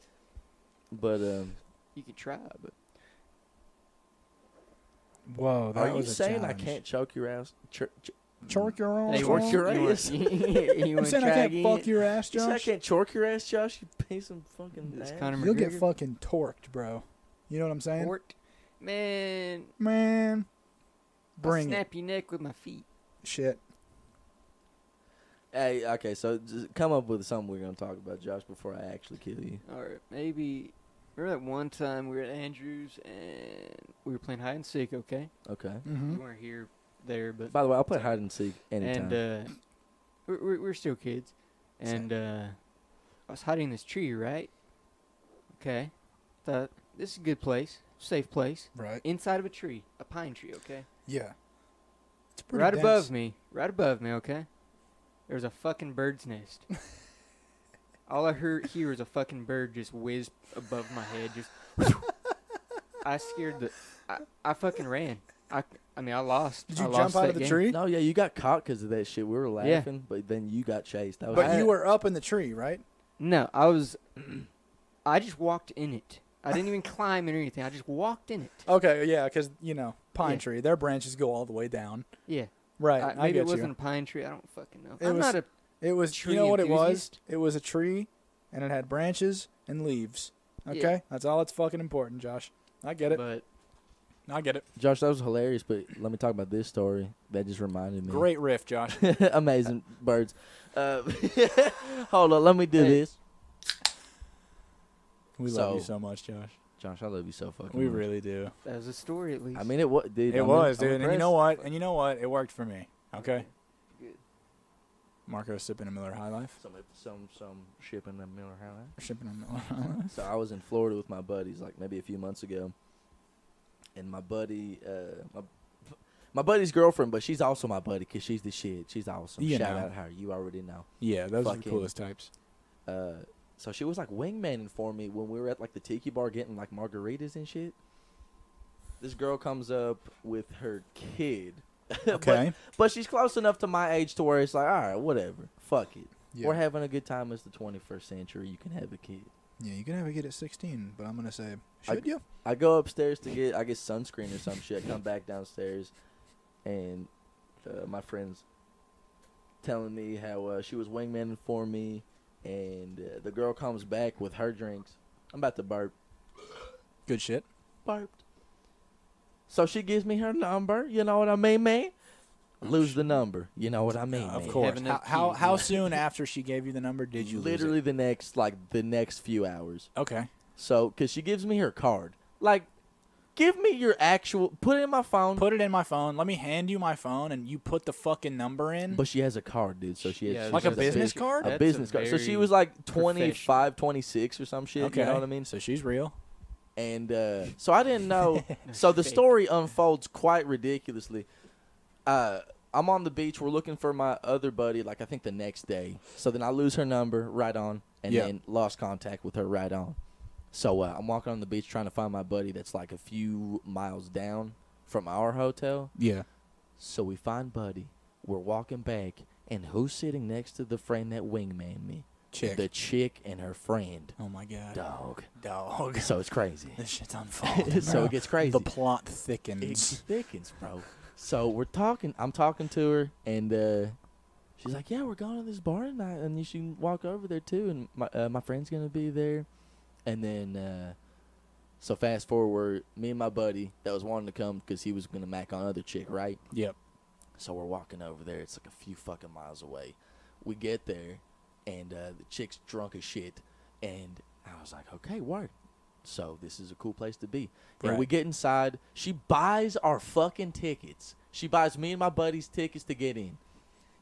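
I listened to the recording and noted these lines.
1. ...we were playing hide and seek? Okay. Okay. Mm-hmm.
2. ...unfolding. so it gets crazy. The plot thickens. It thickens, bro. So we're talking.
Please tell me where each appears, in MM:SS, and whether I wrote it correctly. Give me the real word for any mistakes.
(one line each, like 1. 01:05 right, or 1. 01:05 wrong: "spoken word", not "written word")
1. 00:34 right
2. 03:47 right.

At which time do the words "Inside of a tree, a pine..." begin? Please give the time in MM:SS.
00:49.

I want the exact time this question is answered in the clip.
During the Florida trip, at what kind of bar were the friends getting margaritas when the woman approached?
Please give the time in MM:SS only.
02:15.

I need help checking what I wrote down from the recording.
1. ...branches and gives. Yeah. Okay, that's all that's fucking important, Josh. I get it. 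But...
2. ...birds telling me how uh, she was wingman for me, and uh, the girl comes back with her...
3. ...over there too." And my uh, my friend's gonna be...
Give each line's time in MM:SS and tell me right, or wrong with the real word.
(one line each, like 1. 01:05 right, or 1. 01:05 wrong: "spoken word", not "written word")
1. 01:28 wrong: "leaves", not "gives"
2. 02:38 wrong: "friends", not "birds"
3. 03:57 right.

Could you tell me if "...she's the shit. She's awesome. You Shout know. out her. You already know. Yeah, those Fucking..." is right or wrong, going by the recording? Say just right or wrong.
right.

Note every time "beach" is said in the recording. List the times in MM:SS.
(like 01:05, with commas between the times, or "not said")
03:23, 03:31.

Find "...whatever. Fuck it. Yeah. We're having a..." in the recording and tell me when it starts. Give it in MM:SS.
02:24.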